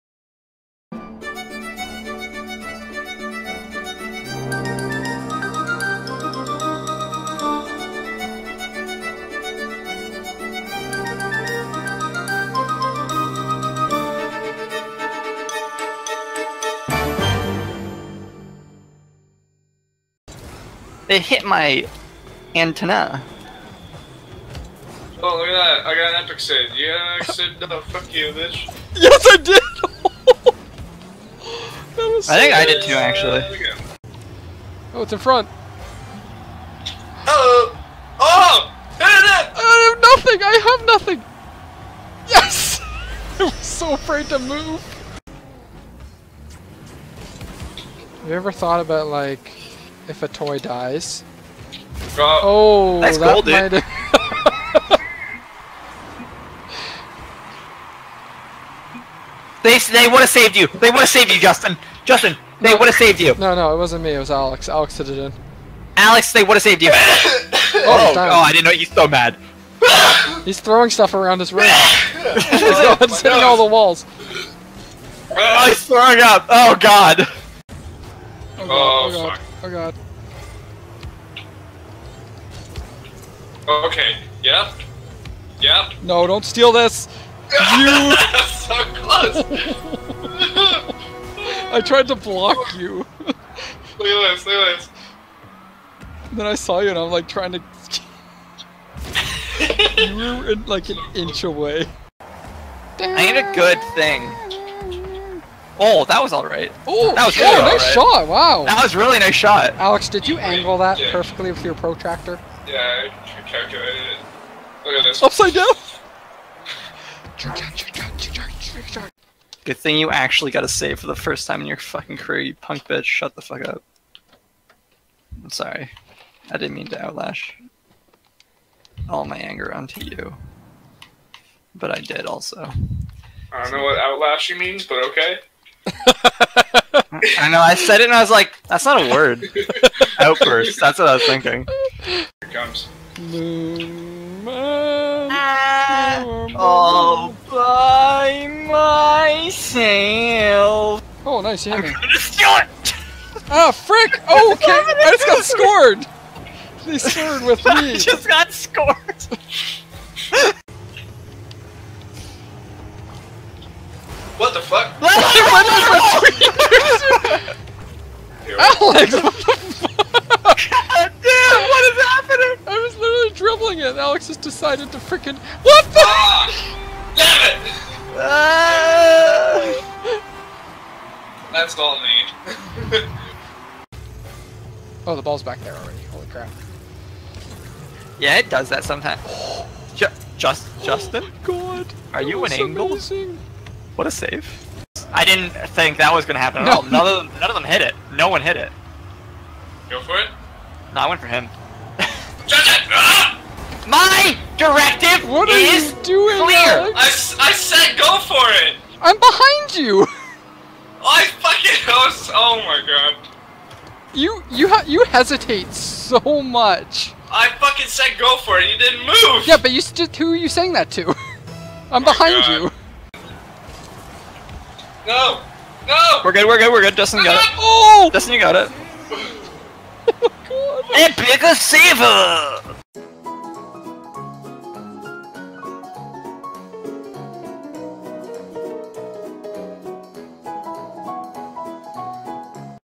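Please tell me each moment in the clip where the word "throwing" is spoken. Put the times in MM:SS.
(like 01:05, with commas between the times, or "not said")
01:10, 01:15.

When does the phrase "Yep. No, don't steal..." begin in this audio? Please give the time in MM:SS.
01:25.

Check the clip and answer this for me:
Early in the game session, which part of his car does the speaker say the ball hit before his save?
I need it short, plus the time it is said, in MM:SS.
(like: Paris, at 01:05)
antenna, at 00:22.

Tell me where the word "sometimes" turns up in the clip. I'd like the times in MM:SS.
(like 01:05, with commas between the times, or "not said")
03:08.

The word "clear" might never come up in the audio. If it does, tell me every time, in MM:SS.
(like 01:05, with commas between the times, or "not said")
03:26.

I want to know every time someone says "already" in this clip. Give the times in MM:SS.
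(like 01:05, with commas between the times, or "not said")
03:05.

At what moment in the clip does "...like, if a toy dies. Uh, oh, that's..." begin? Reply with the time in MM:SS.
00:49.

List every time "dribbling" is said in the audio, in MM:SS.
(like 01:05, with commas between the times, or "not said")
02:53.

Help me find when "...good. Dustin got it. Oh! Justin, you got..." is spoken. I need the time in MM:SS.
03:46.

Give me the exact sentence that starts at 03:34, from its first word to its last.
You you you hesitate so much.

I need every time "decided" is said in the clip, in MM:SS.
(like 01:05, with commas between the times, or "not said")
02:54.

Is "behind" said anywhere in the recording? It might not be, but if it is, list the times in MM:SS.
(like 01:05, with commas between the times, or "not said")
03:29, 03:42.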